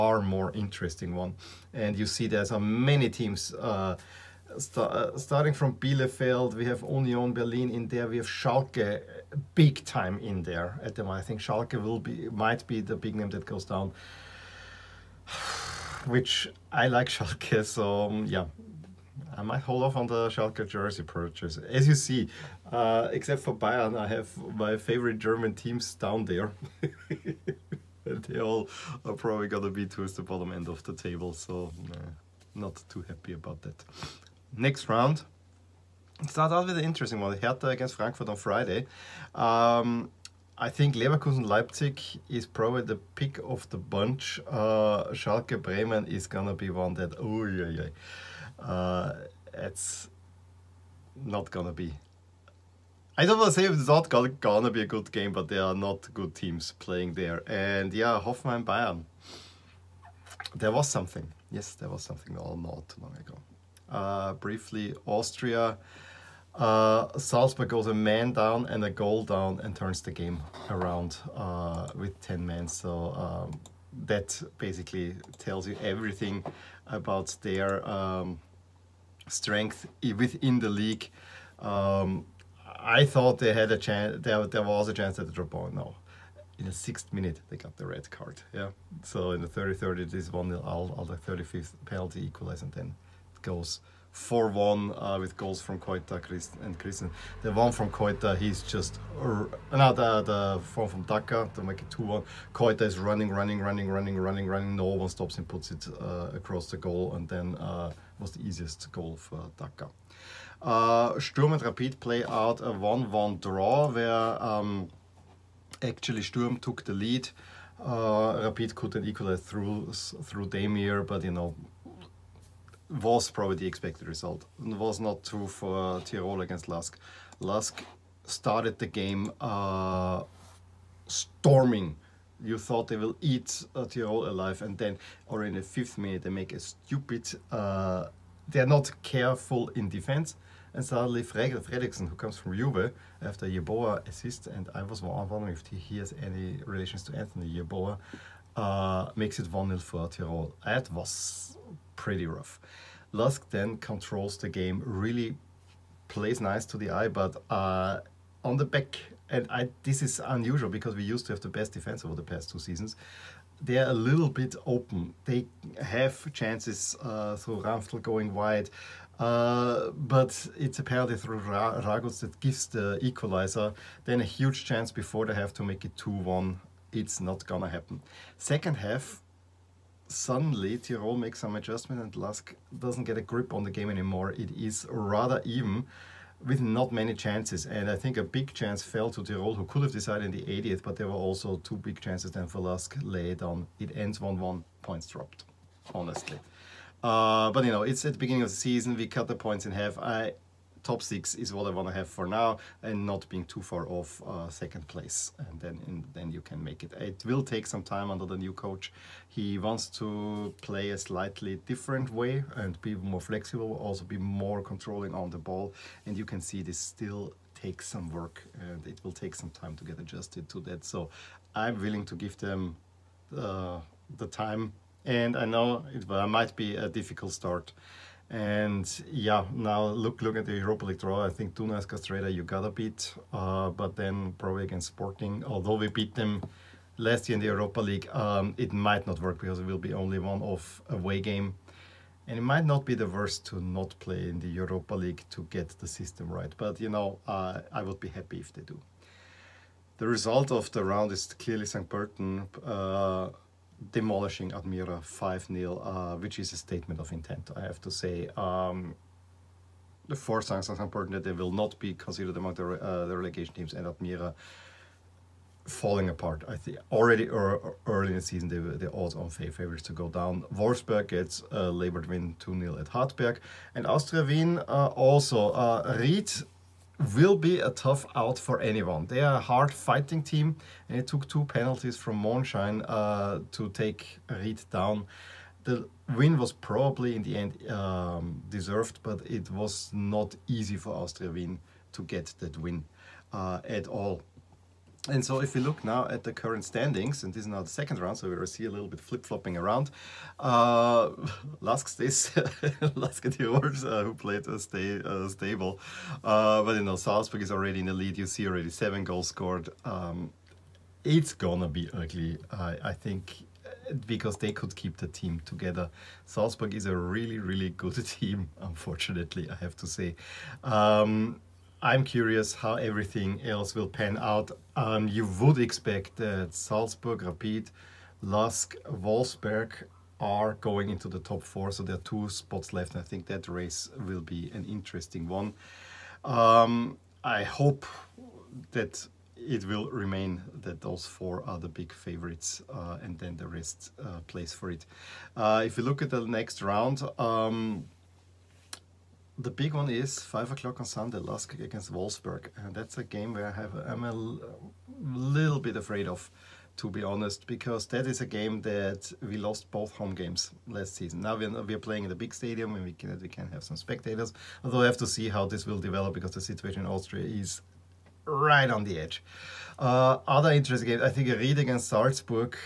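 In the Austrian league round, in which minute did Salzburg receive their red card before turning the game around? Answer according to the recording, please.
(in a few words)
sixth minute.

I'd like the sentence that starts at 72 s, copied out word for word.
So um, that basically tells you everything about their um, strength within the league.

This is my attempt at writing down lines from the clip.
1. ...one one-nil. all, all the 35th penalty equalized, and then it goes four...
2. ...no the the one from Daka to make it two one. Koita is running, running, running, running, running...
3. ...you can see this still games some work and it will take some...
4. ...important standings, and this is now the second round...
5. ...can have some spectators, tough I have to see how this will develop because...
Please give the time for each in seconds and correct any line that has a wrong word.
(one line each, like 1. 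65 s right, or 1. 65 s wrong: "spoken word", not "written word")
1. 90 s right
2. 99 s right
3. 216 s wrong: "takes", not "games"
4. 296 s wrong: "current", not "important"
5. 363 s wrong: "although", not "tough".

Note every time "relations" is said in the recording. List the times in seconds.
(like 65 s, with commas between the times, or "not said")
146 s.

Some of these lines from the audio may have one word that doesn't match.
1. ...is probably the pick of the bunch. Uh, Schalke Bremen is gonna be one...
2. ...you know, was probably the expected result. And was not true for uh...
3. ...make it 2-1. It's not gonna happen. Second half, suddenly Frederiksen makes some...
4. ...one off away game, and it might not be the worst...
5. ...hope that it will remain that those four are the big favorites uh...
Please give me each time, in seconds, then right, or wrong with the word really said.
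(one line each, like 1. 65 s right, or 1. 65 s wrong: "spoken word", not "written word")
1. 42 s right
2. 121 s right
3. 175 s wrong: "Tirol", not "Frederiksen"
4. 240 s right
5. 337 s right.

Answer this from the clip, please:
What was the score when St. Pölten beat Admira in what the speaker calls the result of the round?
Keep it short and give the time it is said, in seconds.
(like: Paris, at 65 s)
5-0, at 255 s.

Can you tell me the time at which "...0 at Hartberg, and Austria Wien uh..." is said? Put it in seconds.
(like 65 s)
272 s.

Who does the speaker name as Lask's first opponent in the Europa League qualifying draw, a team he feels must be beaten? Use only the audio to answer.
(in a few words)
Dunajská Streda.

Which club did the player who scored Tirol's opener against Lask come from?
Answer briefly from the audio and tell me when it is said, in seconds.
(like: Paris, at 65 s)
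Juve, at 142 s.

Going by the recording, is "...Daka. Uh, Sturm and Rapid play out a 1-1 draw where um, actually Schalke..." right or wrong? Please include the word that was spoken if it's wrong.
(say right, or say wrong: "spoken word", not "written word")
wrong: "Sturm", not "Schalke".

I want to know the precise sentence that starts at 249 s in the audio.
The result of the round is clearly St.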